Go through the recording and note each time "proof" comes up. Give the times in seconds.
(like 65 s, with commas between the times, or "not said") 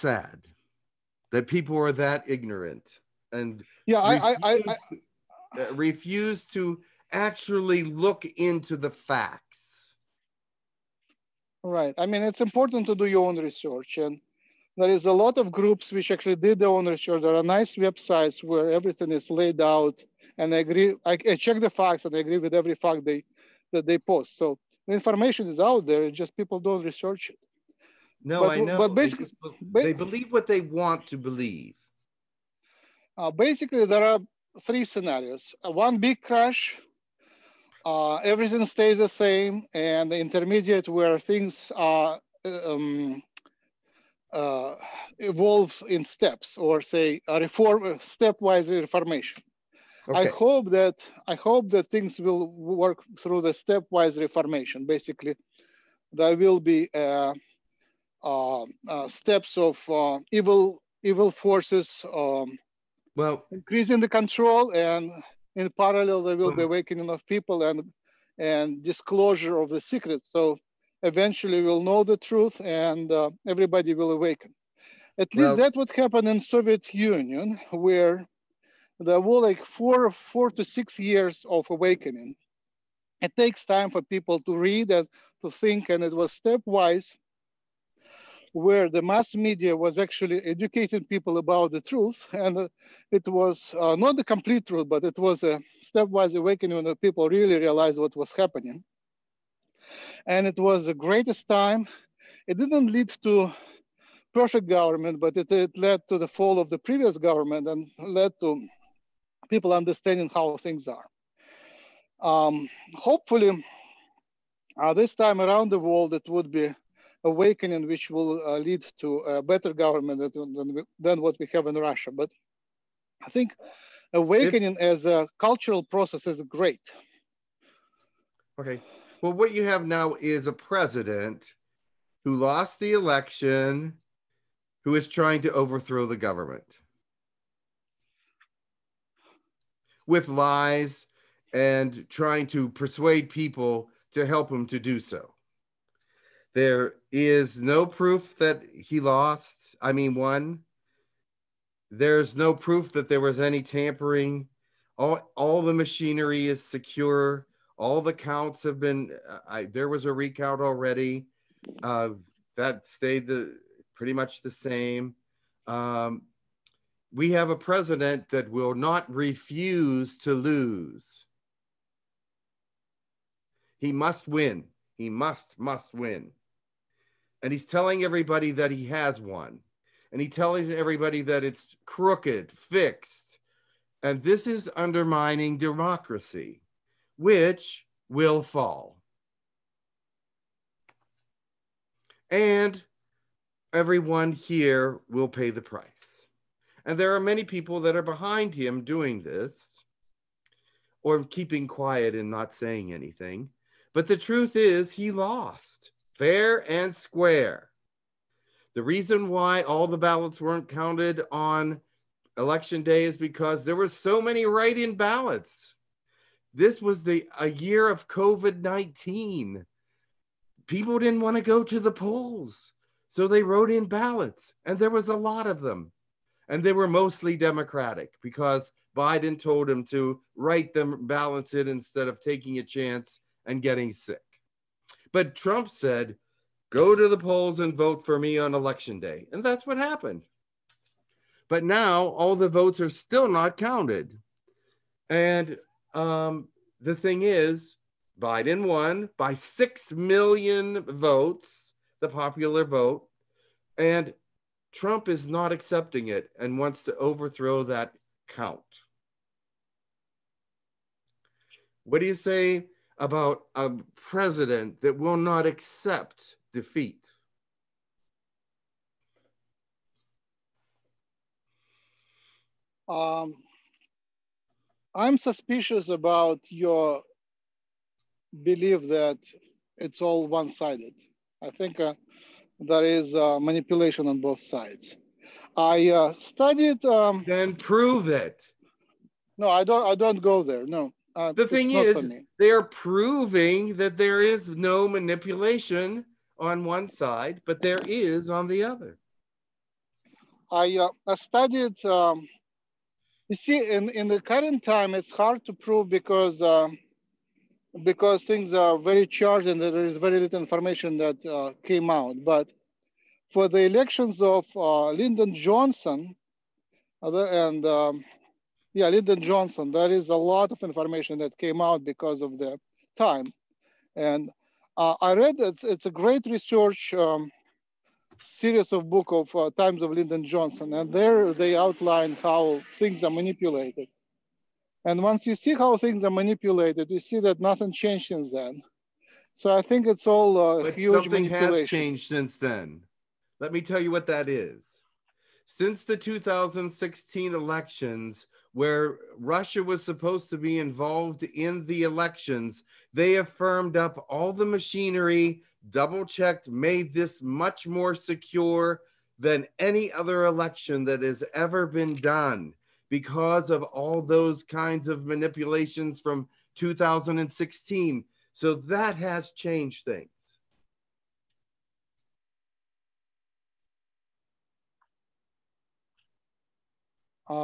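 147 s, 152 s.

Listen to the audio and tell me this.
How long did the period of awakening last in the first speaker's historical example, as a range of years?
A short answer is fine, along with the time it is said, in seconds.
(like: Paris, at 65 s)
4 to 6 years, at 80 s.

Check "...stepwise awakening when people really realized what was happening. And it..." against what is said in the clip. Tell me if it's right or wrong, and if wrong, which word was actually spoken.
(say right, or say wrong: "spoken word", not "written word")
right.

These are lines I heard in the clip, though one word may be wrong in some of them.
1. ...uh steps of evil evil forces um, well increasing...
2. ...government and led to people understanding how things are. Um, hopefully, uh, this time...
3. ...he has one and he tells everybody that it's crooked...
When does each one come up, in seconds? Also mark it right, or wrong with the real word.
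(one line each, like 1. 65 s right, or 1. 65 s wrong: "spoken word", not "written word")
1. 58 s right
2. 107 s right
3. 178 s right.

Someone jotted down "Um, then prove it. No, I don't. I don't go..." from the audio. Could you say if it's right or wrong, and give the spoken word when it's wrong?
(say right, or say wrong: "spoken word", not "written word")
right.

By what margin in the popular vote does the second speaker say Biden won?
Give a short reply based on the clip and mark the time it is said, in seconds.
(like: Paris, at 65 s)
6 million votes, at 249 s.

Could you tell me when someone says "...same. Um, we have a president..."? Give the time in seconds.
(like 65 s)
164 s.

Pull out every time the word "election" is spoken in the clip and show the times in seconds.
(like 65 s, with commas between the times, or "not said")
132 s, 212 s, 238 s, 313 s, 347 s, 351 s, 360 s.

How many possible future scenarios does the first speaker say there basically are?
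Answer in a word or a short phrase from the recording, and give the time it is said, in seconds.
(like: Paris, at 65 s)
3, at 34 s.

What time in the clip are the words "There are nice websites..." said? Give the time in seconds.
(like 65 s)
17 s.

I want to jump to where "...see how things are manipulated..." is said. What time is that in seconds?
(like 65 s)
335 s.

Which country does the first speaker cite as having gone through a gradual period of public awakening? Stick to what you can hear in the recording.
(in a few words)
Soviet Union.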